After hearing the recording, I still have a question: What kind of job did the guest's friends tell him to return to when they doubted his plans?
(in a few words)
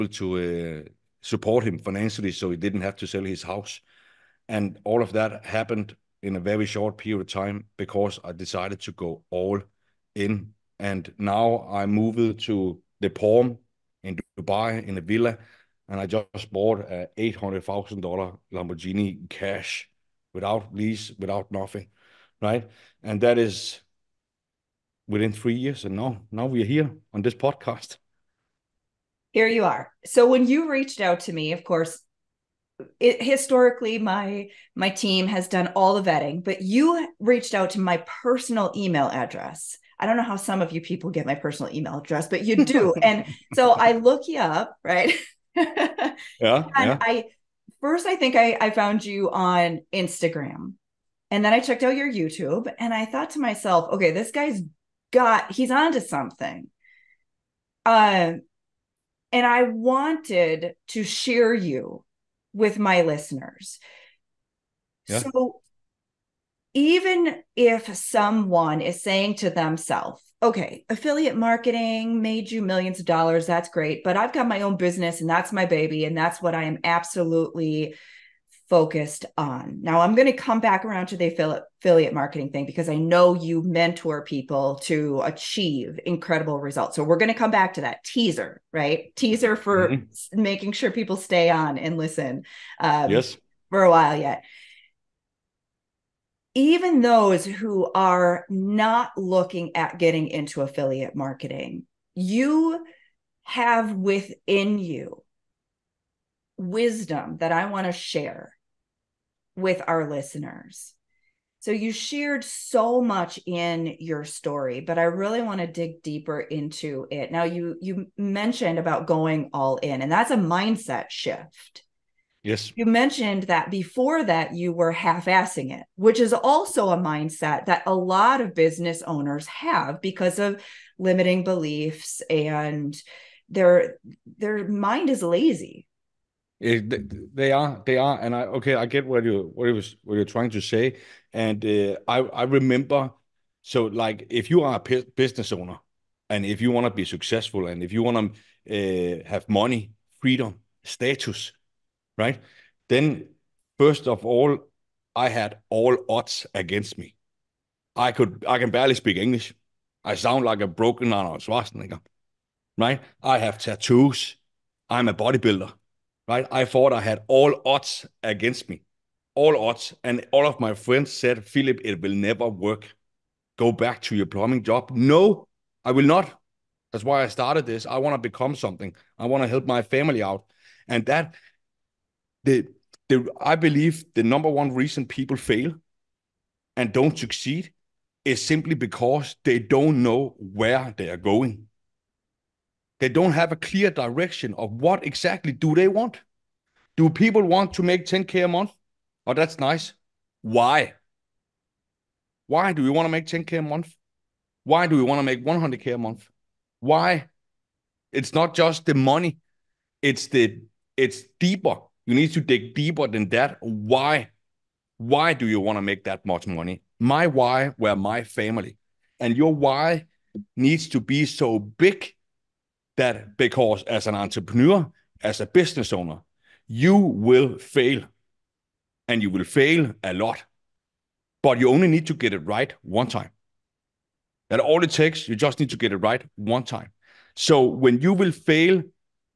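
Plumbing.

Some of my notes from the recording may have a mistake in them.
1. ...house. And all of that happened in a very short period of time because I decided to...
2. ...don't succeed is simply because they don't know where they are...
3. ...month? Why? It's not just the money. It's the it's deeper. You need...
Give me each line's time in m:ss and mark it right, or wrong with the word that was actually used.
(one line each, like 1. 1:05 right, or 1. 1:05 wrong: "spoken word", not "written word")
1. 0:03 right
2. 3:06 right
3. 3:25 right.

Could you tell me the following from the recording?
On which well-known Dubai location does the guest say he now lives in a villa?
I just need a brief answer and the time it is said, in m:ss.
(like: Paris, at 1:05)
The Palm, at 0:13.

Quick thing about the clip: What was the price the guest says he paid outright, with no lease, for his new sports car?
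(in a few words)
$800,000.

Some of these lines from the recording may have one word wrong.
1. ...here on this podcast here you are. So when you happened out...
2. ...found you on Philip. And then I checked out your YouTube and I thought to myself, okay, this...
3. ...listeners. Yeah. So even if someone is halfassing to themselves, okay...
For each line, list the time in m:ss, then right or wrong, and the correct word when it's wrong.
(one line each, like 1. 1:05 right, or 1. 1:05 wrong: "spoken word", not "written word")
1. 0:26 wrong: "reached", not "happened"
2. 0:48 wrong: "Instagram", not "Philip"
3. 1:03 wrong: "saying", not "halfassing".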